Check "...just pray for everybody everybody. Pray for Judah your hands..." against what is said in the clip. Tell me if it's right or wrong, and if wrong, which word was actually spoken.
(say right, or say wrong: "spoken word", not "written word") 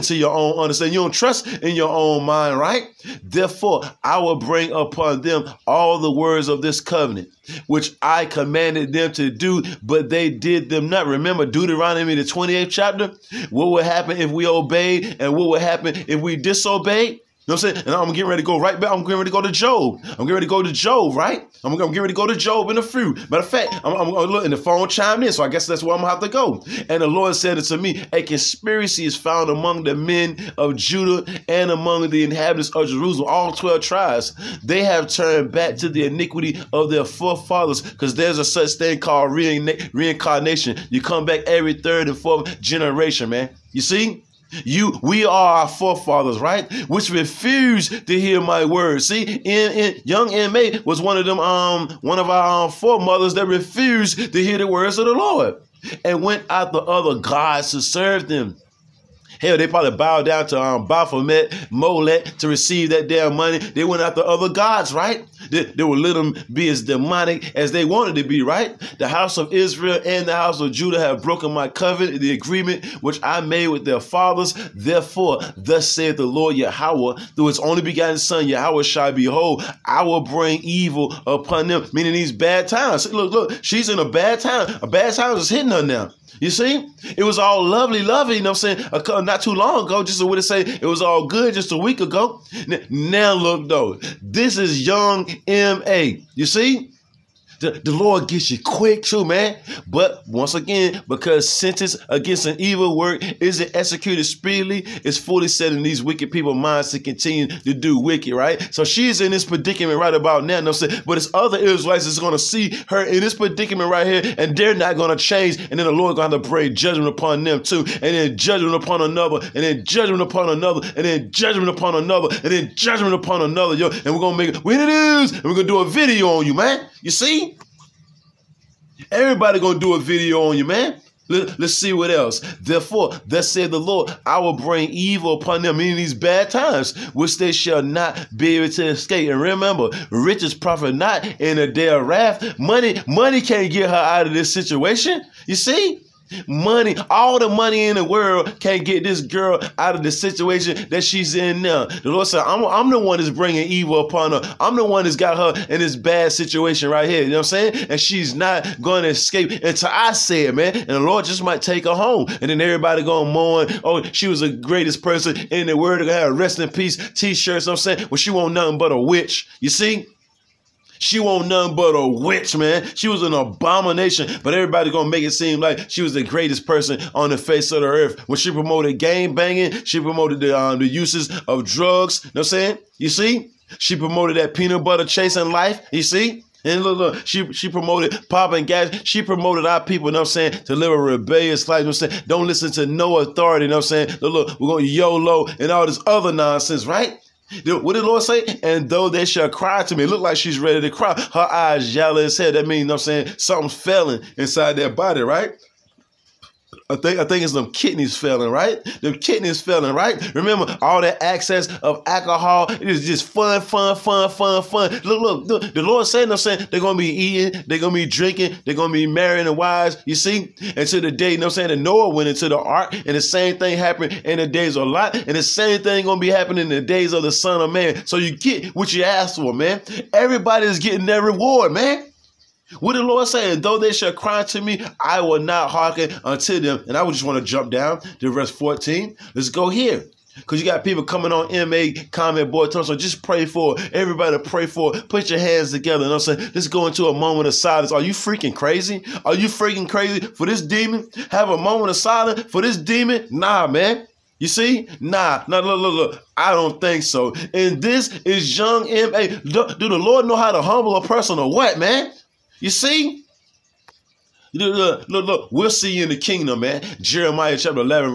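wrong: "Put", not "Judah".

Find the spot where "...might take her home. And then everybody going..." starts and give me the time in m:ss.
2:41.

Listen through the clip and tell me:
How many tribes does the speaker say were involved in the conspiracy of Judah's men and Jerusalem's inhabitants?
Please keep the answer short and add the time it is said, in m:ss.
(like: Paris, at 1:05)
12, at 0:33.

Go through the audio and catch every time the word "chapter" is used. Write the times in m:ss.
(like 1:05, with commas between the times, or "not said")
0:12, 4:27.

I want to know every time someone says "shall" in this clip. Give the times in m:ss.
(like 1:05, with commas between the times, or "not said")
1:18, 2:17, 3:19, 3:53.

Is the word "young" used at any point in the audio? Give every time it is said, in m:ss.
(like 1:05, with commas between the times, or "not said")
0:50, 1:34, 4:18.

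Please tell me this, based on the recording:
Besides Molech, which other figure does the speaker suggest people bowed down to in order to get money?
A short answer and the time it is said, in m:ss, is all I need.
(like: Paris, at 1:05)
Baphomet, at 1:00.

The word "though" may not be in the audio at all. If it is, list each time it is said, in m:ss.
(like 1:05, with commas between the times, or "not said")
1:33, 3:18, 3:53.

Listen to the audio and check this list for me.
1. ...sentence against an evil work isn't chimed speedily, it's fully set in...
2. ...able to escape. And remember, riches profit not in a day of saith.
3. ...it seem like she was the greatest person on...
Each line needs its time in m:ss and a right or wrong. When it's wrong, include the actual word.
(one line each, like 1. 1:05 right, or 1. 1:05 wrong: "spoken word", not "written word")
1. 1:41 wrong: "executed", not "chimed"
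2. 2:18 wrong: "wrath", not "saith"
3. 2:55 right.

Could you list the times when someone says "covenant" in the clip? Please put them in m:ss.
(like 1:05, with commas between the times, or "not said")
0:06, 1:11.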